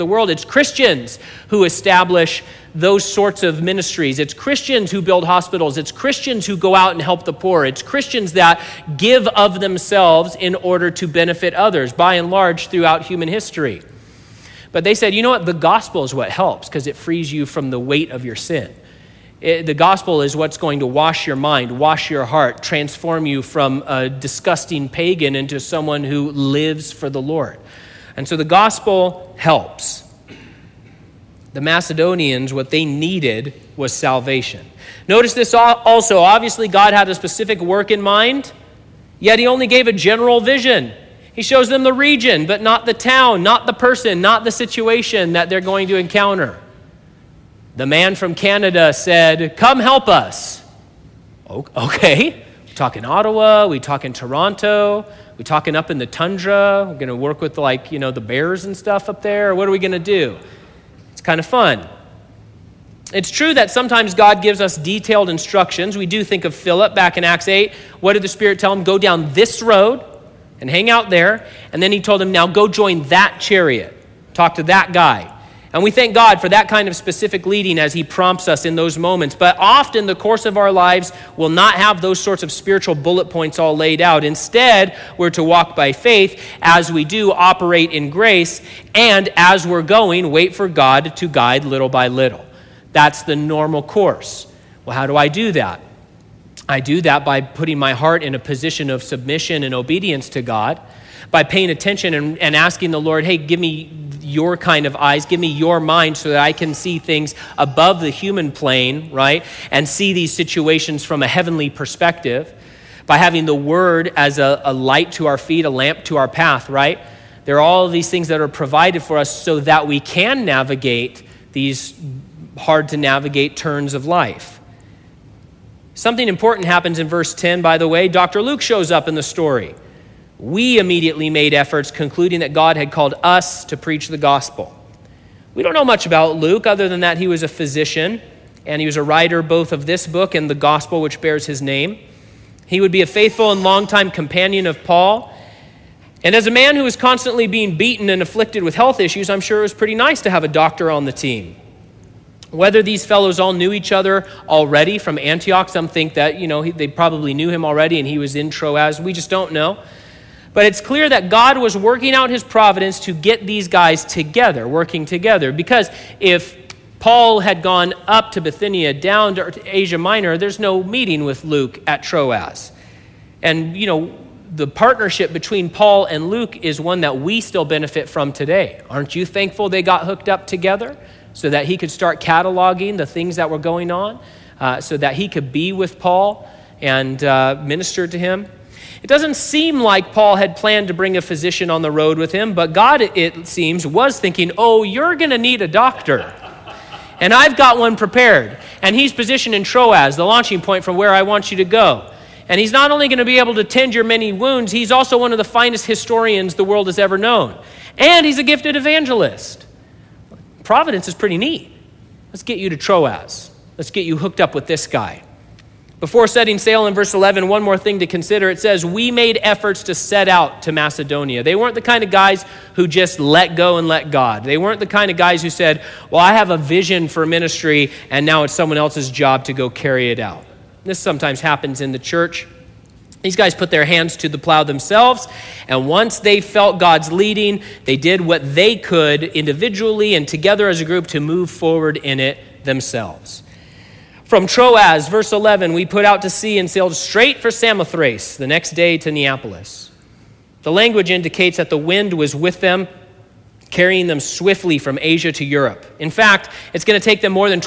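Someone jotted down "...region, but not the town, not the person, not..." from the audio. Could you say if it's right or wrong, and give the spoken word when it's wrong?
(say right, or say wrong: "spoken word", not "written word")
right.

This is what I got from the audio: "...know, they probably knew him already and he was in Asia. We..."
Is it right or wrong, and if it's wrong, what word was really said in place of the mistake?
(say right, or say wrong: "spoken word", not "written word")
wrong: "Troas", not "Asia".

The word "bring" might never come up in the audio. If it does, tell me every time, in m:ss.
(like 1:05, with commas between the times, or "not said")
3:10.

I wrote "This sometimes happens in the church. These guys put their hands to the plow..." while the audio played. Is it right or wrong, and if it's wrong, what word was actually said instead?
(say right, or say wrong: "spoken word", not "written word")
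right.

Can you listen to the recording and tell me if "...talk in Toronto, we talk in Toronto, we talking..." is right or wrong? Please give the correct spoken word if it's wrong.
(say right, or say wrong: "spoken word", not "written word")
wrong: "Ottawa", not "Toronto".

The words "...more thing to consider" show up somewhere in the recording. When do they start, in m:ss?
3:37.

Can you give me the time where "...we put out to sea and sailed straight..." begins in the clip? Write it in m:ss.
4:05.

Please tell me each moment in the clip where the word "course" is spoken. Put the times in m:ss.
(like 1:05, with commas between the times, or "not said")
1:20, 1:33.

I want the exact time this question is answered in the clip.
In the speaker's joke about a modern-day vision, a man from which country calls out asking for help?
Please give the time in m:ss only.
0:48.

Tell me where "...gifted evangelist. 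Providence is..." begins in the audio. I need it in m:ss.
3:28.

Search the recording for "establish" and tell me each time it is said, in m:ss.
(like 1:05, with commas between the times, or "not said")
0:01.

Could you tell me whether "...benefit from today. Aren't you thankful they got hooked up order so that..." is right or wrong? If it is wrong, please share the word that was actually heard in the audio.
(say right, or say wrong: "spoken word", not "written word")
wrong: "together", not "order".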